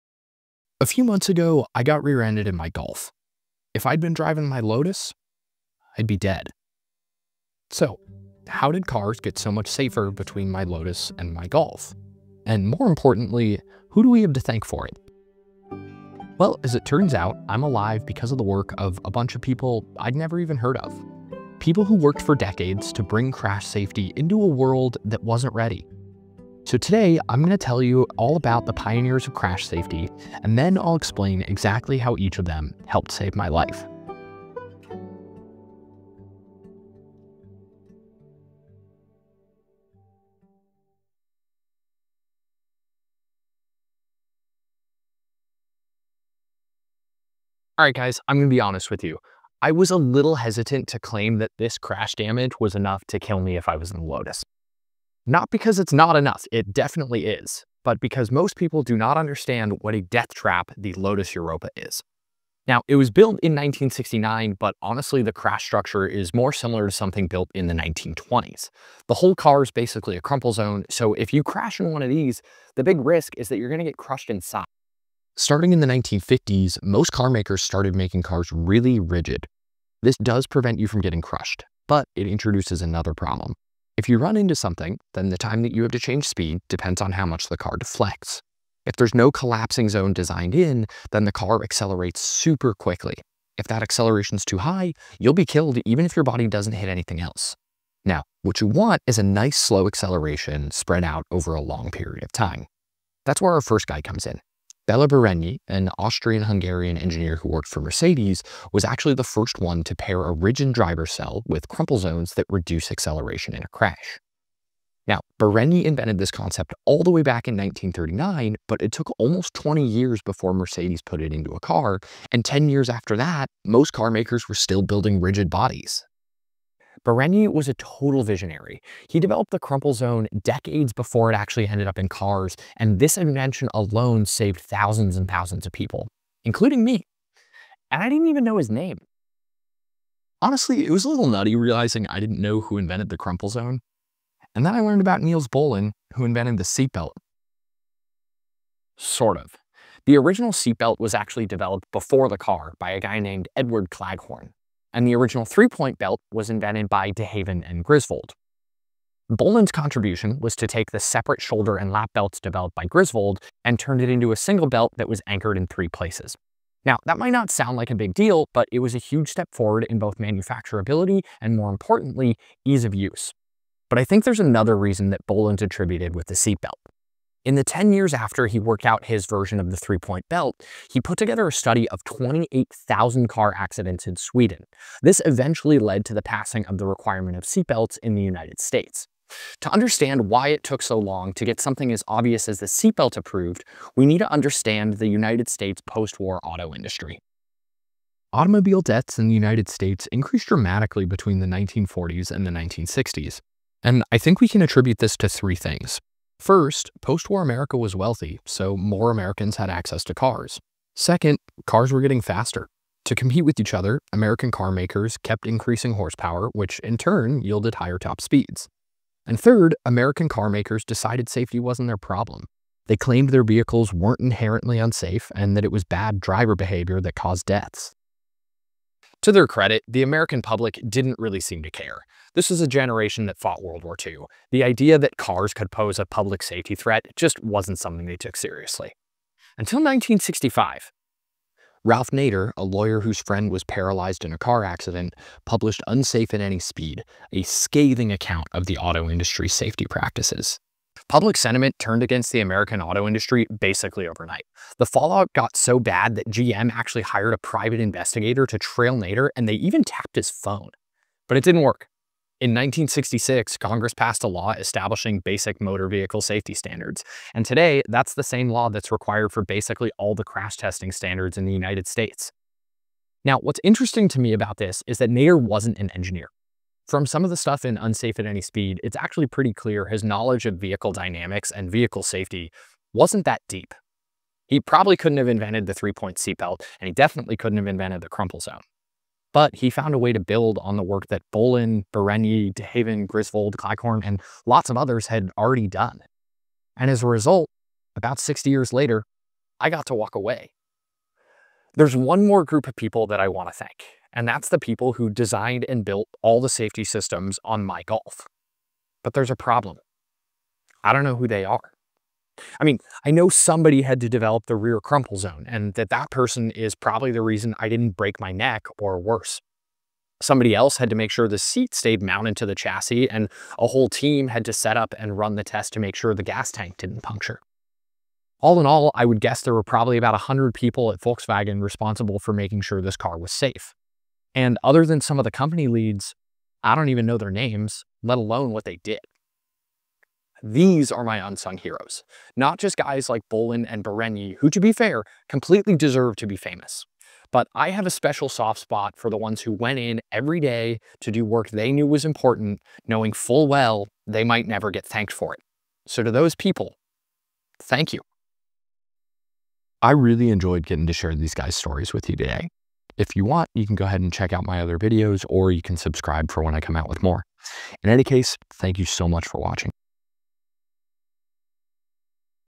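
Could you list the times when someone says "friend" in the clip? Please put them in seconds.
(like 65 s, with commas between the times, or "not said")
243 s.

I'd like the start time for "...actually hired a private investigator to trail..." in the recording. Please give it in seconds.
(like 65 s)
256 s.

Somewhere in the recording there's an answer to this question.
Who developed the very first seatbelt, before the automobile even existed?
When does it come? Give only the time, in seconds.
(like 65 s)
153 s.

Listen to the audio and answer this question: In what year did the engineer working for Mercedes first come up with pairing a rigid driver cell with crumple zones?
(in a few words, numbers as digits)
1939.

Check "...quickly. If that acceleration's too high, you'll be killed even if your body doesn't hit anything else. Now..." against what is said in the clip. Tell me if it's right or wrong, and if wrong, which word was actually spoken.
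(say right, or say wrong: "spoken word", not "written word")
right.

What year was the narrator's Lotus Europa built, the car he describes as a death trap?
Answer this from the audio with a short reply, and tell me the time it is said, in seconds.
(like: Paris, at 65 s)
1969, at 63 s.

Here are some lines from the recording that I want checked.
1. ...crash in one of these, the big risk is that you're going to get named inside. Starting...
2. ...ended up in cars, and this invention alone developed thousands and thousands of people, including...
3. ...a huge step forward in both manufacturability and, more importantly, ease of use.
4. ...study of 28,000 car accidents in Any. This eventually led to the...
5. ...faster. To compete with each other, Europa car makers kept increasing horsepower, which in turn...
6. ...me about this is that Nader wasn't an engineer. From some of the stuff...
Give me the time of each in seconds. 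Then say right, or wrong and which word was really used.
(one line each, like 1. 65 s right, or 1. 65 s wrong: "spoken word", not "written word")
1. 71 s wrong: "crushed", not "named"
2. 131 s wrong: "saved", not "developed"
3. 168 s right
4. 181 s wrong: "Sweden", not "Any"
5. 212 s wrong: "American", not "Europa"
6. 274 s right.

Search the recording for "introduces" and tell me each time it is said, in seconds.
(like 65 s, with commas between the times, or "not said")
82 s.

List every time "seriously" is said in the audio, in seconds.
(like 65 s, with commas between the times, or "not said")
238 s.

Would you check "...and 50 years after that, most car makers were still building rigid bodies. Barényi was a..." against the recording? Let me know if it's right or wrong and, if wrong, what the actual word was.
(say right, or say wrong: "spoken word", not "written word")
wrong: "10", not "50".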